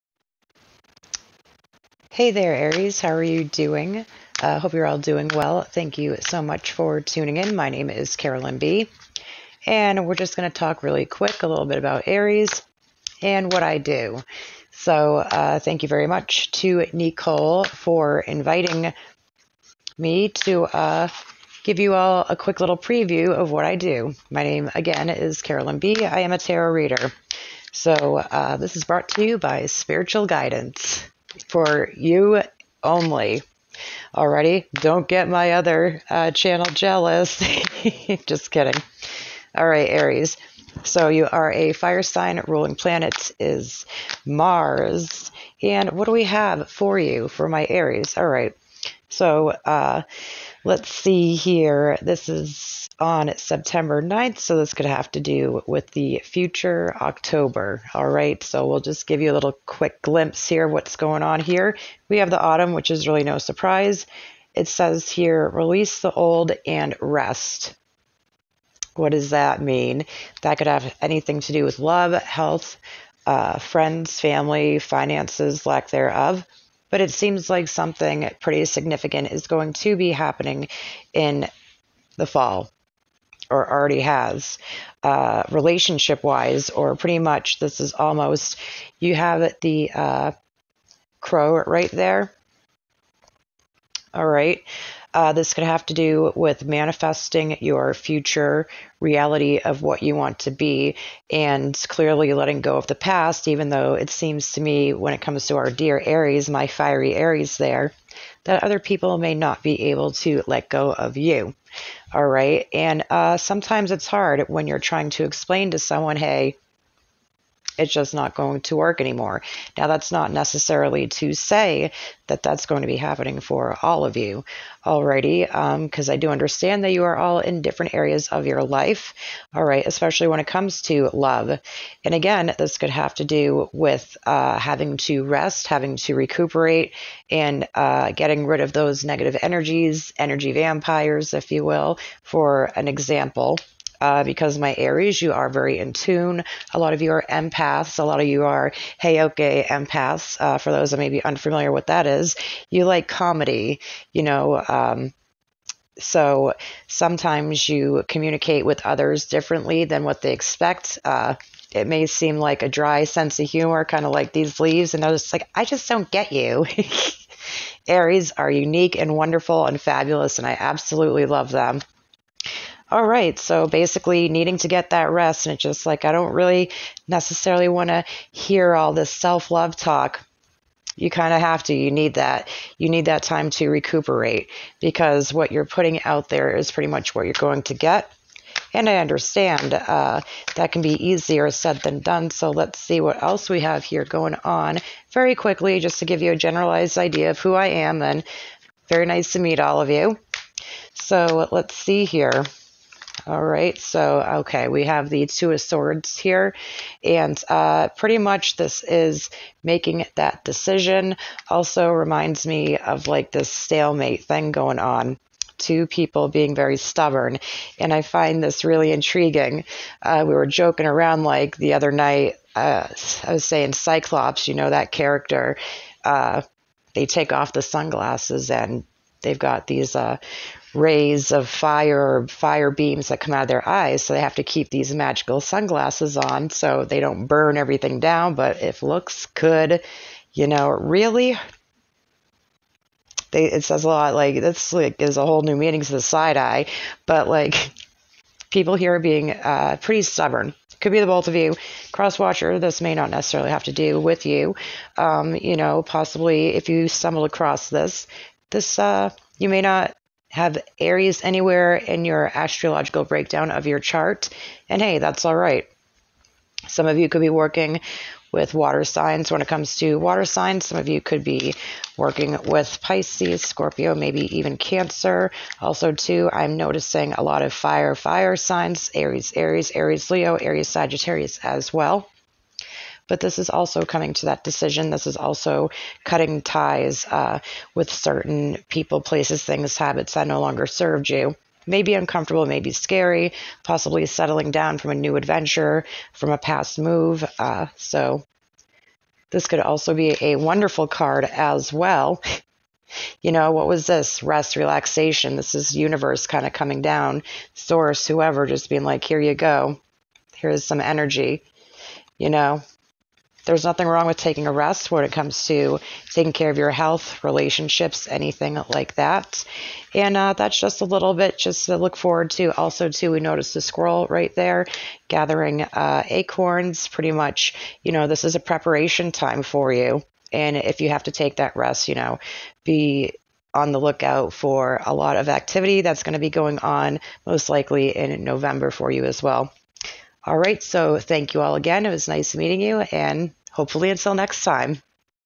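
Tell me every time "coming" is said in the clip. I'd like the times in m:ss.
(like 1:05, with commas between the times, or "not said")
4:43, 5:06.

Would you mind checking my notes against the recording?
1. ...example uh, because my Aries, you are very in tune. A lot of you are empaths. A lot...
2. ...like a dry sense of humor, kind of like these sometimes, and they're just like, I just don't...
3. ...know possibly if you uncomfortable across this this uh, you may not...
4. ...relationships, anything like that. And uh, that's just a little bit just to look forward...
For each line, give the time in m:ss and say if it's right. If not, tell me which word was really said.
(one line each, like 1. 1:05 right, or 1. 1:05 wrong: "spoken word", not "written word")
1. 2:22 right
2. 2:42 wrong: "leaves", not "sometimes"
3. 4:15 wrong: "stumble", not "uncomfortable"
4. 5:17 right.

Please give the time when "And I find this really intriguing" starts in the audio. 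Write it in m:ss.
3:37.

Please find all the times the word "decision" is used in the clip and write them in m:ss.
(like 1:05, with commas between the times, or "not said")
3:30, 4:44.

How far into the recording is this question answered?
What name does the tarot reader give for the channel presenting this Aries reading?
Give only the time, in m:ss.
0:29.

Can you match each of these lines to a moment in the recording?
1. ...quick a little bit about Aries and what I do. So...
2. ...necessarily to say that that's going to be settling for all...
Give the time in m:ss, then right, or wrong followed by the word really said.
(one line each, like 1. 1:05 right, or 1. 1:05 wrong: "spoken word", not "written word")
1. 0:11 right
2. 2:00 wrong: "happening", not "settling".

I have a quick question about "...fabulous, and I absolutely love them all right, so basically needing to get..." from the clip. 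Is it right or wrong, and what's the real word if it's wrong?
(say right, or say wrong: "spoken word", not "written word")
right.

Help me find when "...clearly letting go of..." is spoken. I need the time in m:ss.
1:41.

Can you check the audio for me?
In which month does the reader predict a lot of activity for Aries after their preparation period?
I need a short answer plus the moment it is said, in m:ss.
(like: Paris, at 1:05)
November, at 5:38.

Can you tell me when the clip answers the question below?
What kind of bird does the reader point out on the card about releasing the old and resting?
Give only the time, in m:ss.
1:31.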